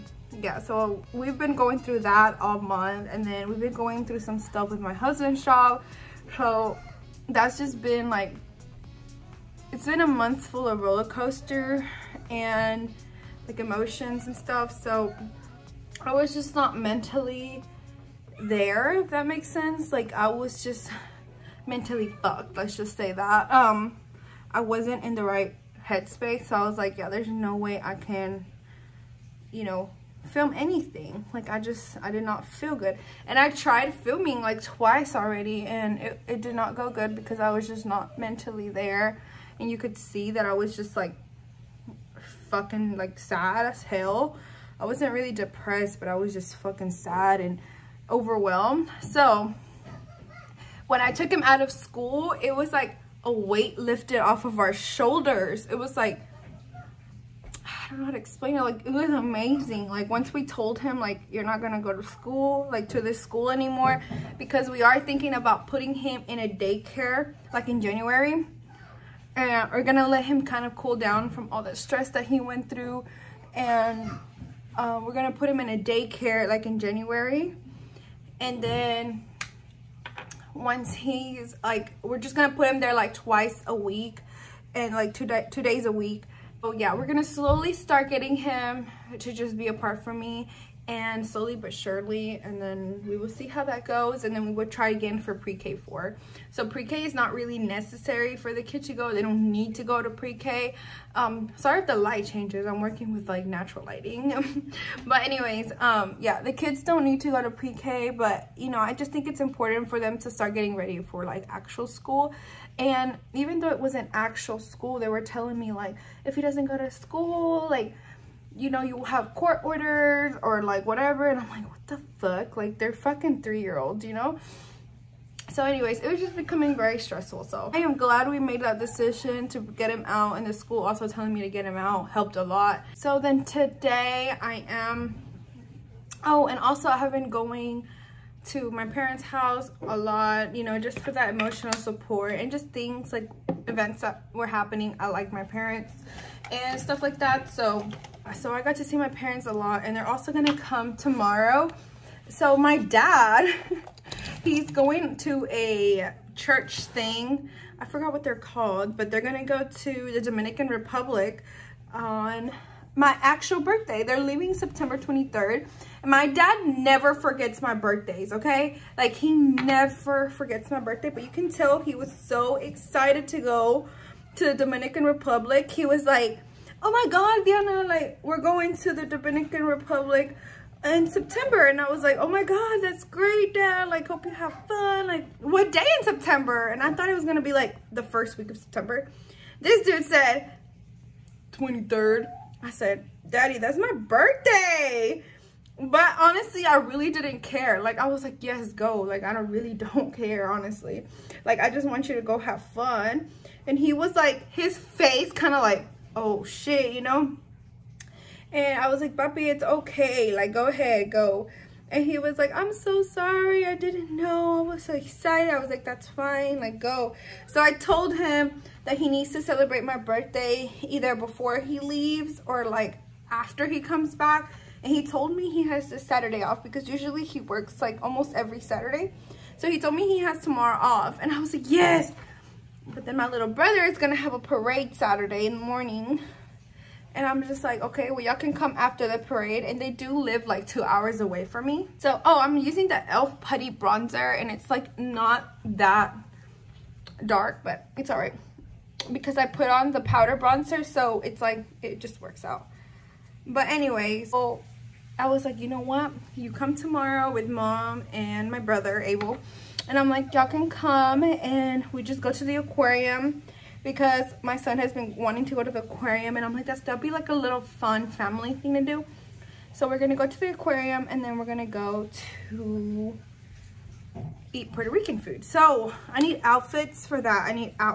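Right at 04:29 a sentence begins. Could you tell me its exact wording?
So we're gonna go to the aquarium and then we're gonna go to eat Puerto Rican food.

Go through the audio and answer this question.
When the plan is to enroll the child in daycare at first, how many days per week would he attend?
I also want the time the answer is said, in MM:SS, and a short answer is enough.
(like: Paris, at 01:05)
2, at 01:25.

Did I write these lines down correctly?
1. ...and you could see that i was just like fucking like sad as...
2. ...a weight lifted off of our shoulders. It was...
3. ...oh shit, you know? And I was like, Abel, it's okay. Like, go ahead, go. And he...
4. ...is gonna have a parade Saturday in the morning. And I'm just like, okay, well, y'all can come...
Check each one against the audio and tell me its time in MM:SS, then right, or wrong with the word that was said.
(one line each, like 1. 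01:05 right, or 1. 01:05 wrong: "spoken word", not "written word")
1. 00:39 right
2. 00:53 right
3. 03:26 wrong: "Papi", not "Abel"
4. 03:53 right.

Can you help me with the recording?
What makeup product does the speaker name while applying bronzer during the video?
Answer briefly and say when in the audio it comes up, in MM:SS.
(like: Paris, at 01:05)
e.l.f. Putty Bronzer, at 04:02.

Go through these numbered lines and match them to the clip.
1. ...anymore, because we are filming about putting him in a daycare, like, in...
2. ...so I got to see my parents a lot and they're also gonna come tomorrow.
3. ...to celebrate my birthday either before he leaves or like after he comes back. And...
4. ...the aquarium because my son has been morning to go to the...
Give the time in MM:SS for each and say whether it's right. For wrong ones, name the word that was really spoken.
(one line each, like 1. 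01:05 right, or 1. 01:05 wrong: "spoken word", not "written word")
1. 01:03 wrong: "thinking", not "filming"
2. 02:28 right
3. 03:39 right
4. 04:22 wrong: "wanting", not "morning".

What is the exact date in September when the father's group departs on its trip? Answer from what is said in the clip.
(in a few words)
September 23rd.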